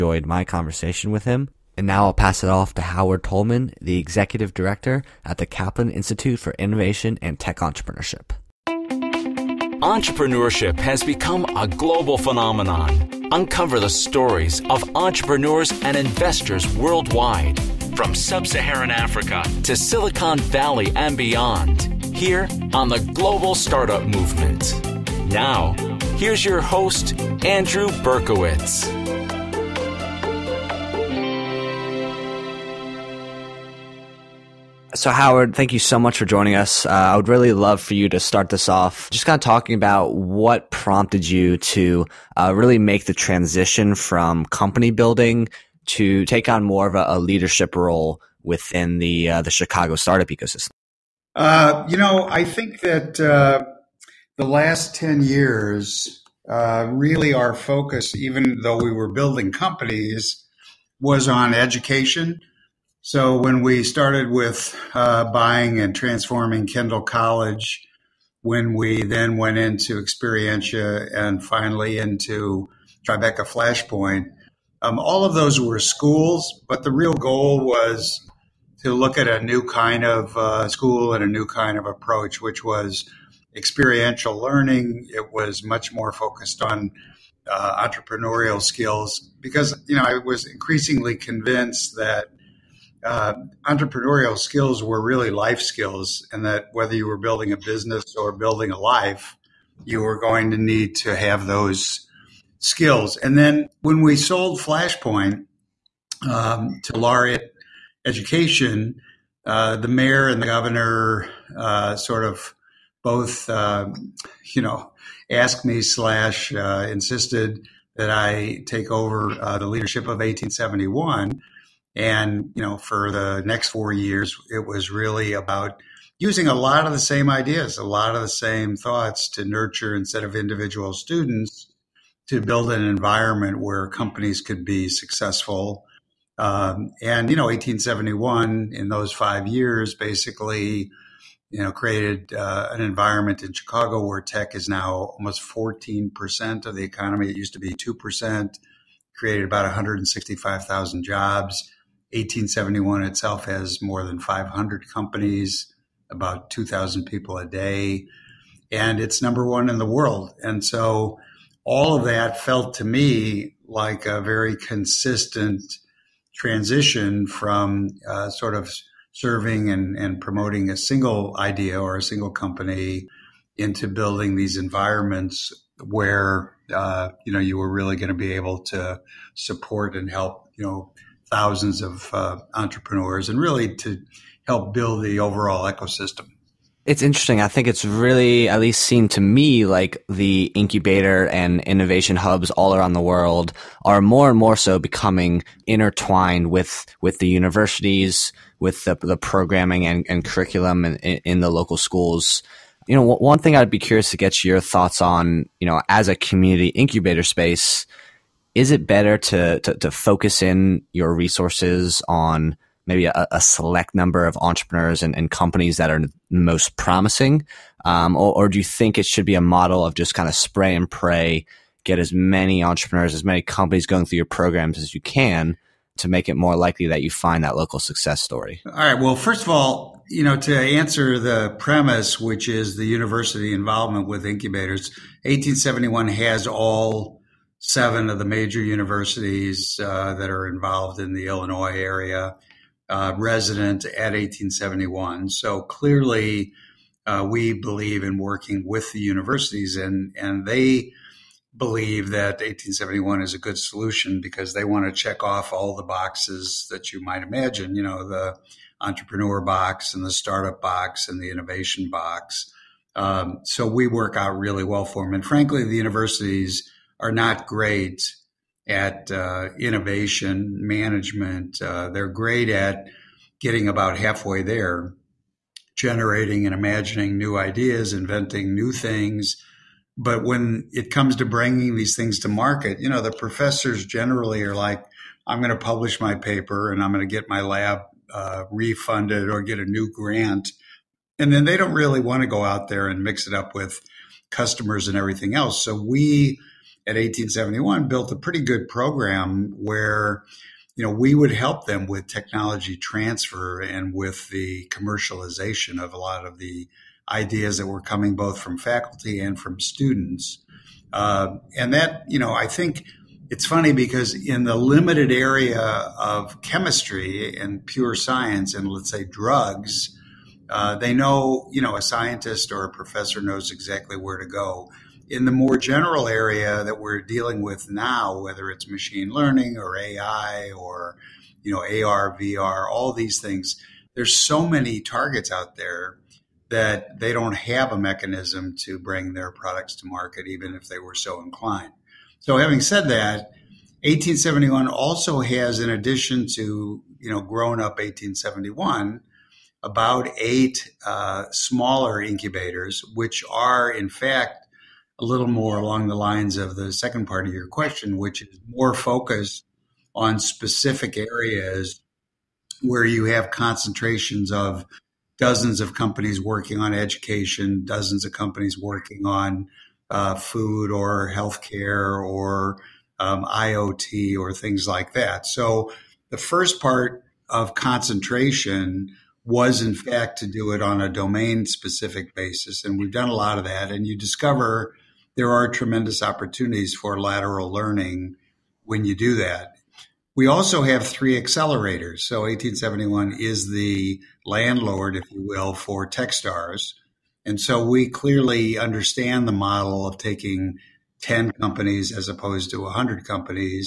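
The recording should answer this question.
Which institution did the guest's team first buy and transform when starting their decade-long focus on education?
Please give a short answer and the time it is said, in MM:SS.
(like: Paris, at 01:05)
Kendall College, at 01:06.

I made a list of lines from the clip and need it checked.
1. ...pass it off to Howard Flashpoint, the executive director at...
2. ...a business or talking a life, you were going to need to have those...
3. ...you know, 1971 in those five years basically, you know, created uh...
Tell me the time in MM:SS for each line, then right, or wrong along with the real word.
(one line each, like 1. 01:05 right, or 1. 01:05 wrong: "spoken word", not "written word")
1. 00:02 wrong: "Tullman", not "Flashpoint"
2. 01:37 wrong: "building", not "talking"
3. 02:17 wrong: "1871", not "1971".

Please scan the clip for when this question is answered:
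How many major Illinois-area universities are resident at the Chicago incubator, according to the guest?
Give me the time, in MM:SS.
03:57.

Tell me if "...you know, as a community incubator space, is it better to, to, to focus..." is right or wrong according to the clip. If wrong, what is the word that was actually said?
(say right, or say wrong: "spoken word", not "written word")
right.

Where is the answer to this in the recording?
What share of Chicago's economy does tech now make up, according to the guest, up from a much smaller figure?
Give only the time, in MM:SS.
02:25.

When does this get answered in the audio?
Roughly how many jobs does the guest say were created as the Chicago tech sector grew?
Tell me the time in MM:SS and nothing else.
02:29.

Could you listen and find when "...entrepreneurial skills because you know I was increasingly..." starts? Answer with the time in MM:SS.
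01:27.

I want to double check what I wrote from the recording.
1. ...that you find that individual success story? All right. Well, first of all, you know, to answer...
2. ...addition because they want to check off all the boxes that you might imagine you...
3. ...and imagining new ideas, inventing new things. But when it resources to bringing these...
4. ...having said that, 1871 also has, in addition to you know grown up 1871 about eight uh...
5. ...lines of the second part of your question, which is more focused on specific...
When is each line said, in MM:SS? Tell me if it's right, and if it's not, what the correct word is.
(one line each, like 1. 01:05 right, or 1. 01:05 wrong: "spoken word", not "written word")
1. 03:46 wrong: "local", not "individual"
2. 04:13 wrong: "solution", not "addition"
3. 04:36 wrong: "comes", not "resources"
4. 05:42 right
5. 05:55 right.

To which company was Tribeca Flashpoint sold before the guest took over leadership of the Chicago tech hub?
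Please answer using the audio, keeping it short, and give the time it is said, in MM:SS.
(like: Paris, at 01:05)
Laureate Education, at 01:46.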